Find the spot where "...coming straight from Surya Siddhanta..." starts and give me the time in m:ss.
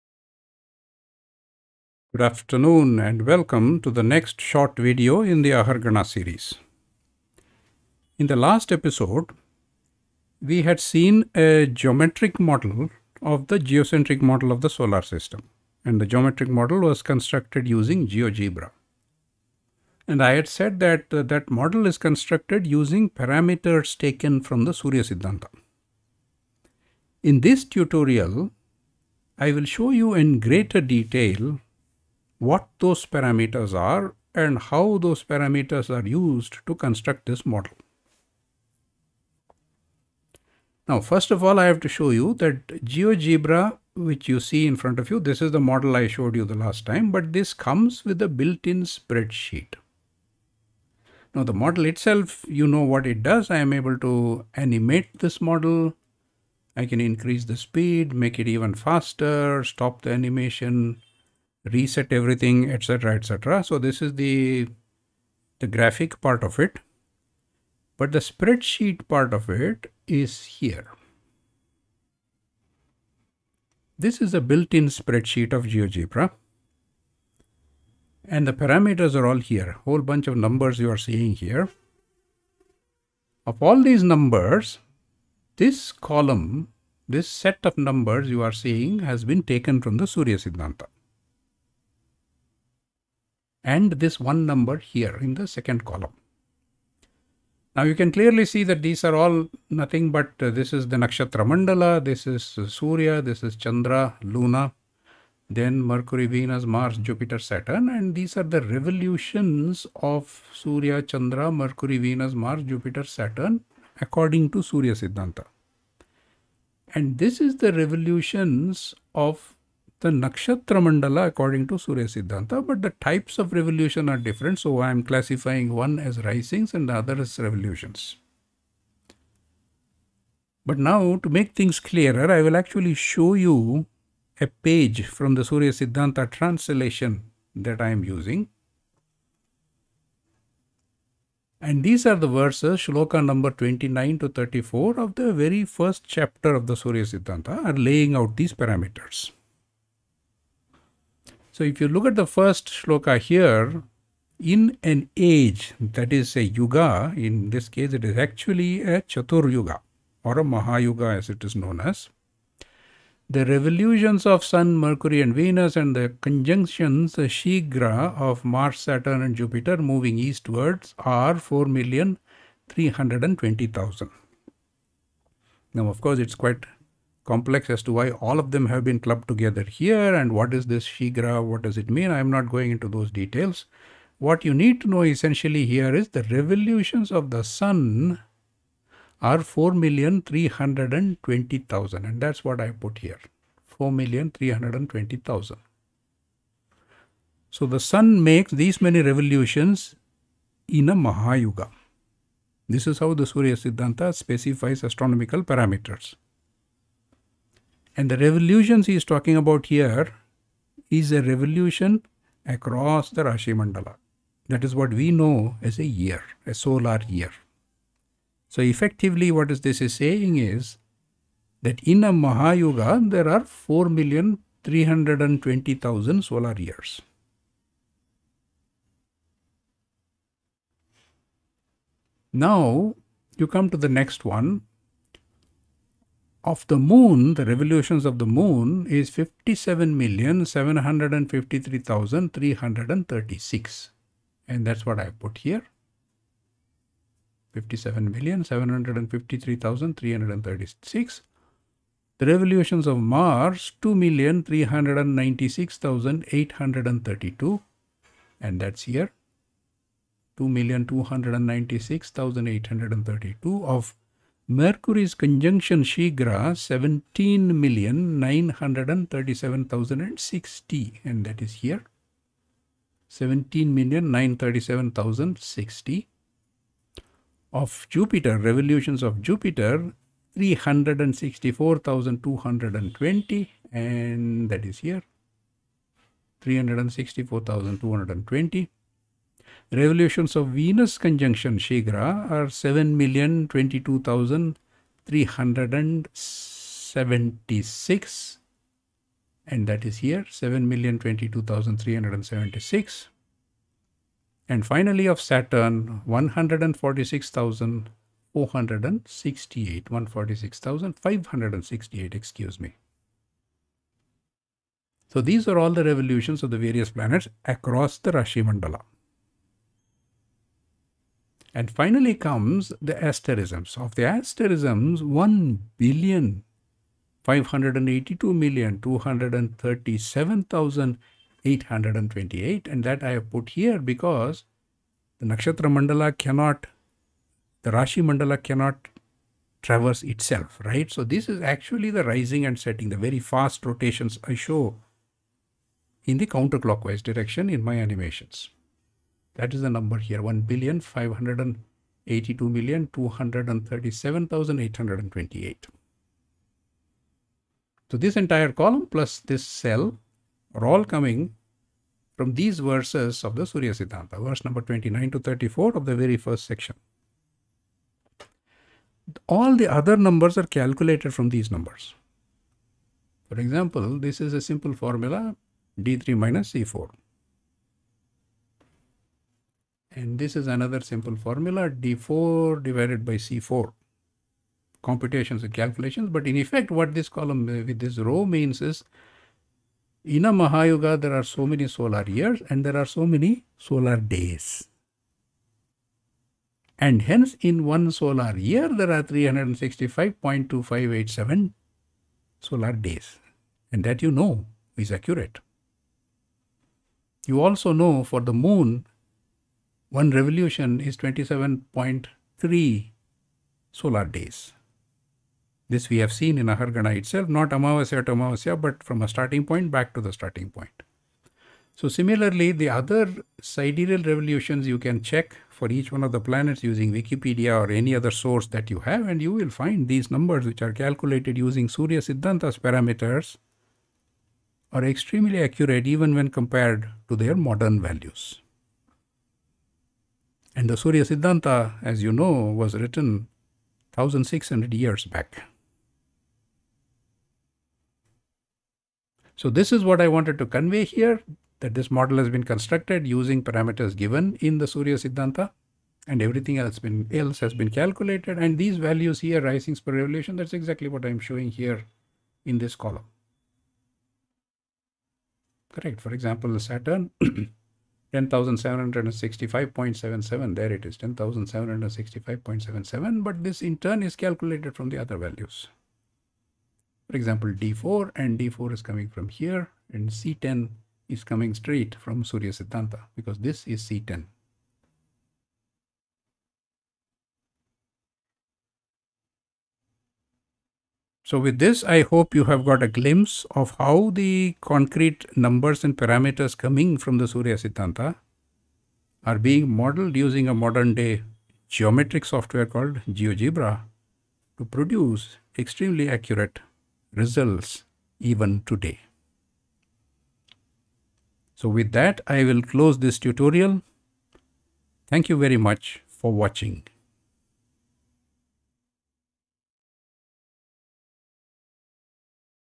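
8:01.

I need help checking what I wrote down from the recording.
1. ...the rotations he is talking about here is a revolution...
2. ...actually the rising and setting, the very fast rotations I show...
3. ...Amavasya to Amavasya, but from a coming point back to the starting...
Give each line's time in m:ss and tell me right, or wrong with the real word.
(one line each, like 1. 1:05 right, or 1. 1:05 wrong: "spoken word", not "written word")
1. 3:28 wrong: "revolutions", not "rotations"
2. 5:41 right
3. 6:57 wrong: "starting", not "coming".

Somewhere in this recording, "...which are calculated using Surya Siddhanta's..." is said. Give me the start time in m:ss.
7:10.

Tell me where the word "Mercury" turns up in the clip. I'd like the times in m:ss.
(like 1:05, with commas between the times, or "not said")
1:45, 1:51, 2:44.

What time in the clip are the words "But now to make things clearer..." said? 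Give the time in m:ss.
2:10.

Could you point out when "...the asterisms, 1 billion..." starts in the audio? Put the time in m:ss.
5:23.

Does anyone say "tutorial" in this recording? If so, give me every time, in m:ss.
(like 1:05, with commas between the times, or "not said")
0:27, 8:33.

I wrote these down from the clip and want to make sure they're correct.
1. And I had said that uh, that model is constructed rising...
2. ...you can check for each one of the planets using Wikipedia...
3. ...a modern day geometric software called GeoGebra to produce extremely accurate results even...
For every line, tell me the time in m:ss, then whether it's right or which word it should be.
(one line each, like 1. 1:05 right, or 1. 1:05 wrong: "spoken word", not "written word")
1. 0:20 wrong: "using", not "rising"
2. 7:04 right
3. 8:20 right.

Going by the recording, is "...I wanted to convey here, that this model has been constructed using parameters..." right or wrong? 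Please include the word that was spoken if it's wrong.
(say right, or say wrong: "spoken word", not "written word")
right.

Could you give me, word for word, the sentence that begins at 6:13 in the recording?
For example, this is a simple formula d3 minus c4.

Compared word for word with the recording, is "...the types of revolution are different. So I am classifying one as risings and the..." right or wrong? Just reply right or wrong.
right.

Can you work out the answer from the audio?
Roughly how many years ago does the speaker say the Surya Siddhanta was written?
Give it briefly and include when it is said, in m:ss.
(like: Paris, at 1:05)
1600, at 7:23.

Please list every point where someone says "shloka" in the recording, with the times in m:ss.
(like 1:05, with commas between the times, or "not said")
2:22, 2:32.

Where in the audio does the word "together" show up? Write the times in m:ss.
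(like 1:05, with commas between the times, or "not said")
2:59.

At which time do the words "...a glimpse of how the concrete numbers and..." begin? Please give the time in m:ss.
8:12.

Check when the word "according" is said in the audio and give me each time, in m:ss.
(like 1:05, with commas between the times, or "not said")
1:54, 2:01.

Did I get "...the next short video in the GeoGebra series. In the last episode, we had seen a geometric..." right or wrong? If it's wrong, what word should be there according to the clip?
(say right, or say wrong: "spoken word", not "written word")
wrong: "Ahargana", not "GeoGebra".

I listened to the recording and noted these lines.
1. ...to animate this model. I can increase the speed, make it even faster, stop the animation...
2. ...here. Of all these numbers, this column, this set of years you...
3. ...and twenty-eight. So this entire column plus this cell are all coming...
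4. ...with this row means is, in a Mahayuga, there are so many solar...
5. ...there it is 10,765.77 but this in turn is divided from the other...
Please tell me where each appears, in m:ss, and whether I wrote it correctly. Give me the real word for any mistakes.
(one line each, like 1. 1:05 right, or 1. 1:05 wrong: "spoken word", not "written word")
1. 0:53 right
2. 1:21 wrong: "numbers", not "years"
3. 5:54 right
4. 6:27 right
5. 7:50 wrong: "calculated", not "divided".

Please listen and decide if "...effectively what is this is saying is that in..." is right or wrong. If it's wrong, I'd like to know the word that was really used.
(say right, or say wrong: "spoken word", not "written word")
right.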